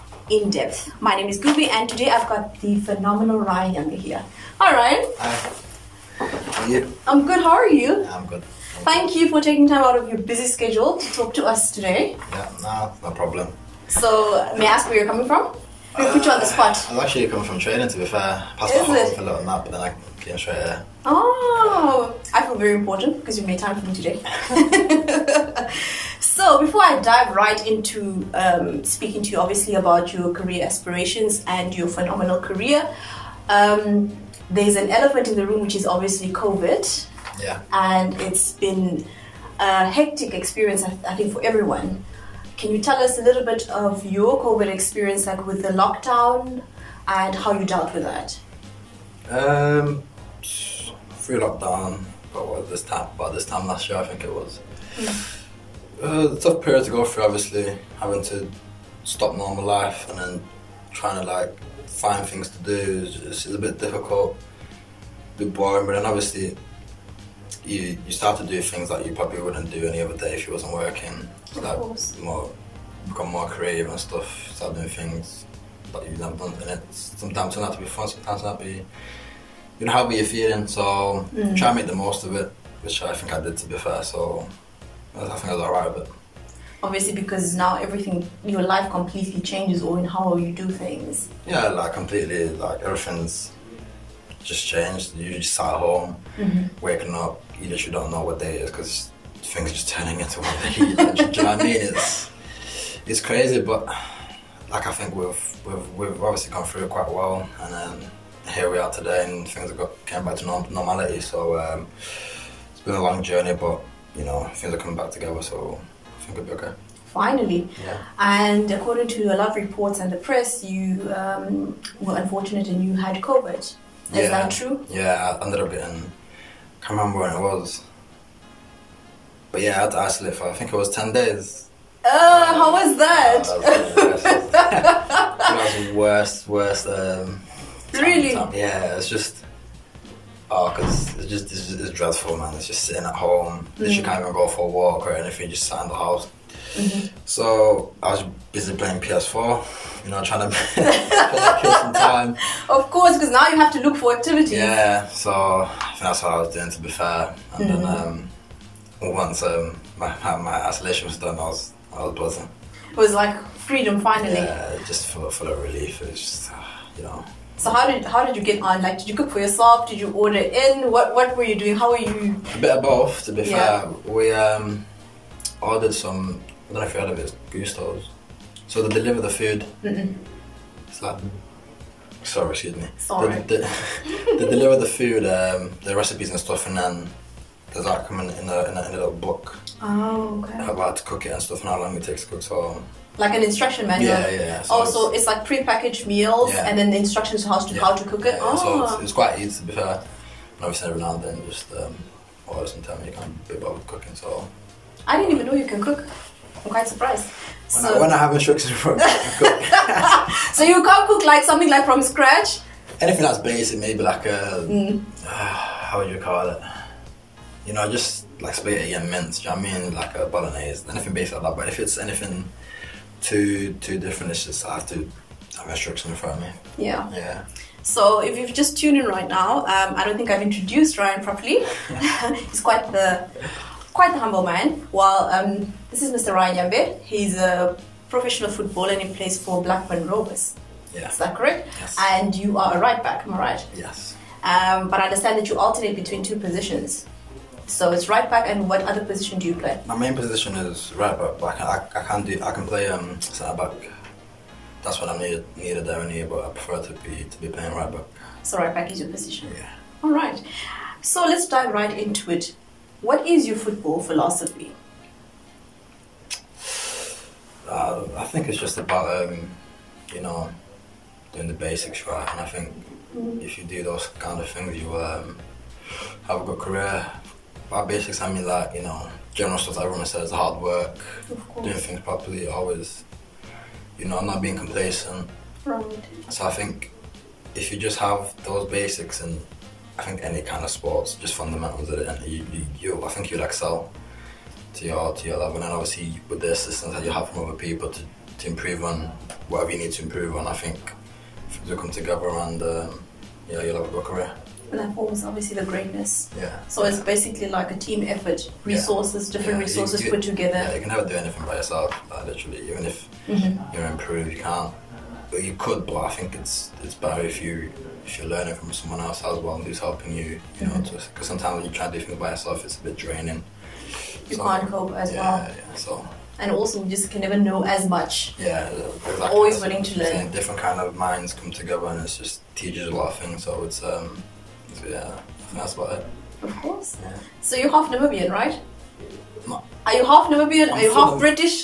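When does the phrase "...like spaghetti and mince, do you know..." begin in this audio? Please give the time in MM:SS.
03:38.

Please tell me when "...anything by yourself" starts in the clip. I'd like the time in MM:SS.
05:11.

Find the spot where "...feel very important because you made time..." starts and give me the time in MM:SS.
00:22.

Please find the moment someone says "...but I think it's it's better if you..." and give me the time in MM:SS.
05:15.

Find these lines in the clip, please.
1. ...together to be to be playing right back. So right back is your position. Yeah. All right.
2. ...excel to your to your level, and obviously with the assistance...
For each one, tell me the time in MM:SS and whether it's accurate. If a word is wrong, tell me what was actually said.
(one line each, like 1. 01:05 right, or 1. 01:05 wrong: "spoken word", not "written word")
1. 04:16 wrong: "prefer", not "together"
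2. 04:53 right.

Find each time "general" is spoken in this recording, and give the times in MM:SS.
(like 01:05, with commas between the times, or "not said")
04:39.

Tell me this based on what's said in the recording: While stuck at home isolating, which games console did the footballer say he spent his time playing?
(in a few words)
PS4.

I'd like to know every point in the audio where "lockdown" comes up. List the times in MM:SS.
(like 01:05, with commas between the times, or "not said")
00:45, 00:51.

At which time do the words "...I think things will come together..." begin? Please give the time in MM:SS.
05:00.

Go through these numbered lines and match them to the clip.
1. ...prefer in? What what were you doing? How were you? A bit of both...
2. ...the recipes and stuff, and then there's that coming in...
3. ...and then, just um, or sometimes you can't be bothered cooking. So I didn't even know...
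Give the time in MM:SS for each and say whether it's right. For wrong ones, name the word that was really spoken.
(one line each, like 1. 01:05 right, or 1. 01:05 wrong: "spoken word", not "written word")
1. 02:50 wrong: "order", not "prefer"
2. 03:05 right
3. 03:21 right.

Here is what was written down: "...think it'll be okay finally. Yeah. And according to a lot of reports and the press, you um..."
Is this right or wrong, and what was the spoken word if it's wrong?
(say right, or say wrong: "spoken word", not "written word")
right.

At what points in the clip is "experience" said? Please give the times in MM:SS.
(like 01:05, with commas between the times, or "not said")
00:40, 00:44.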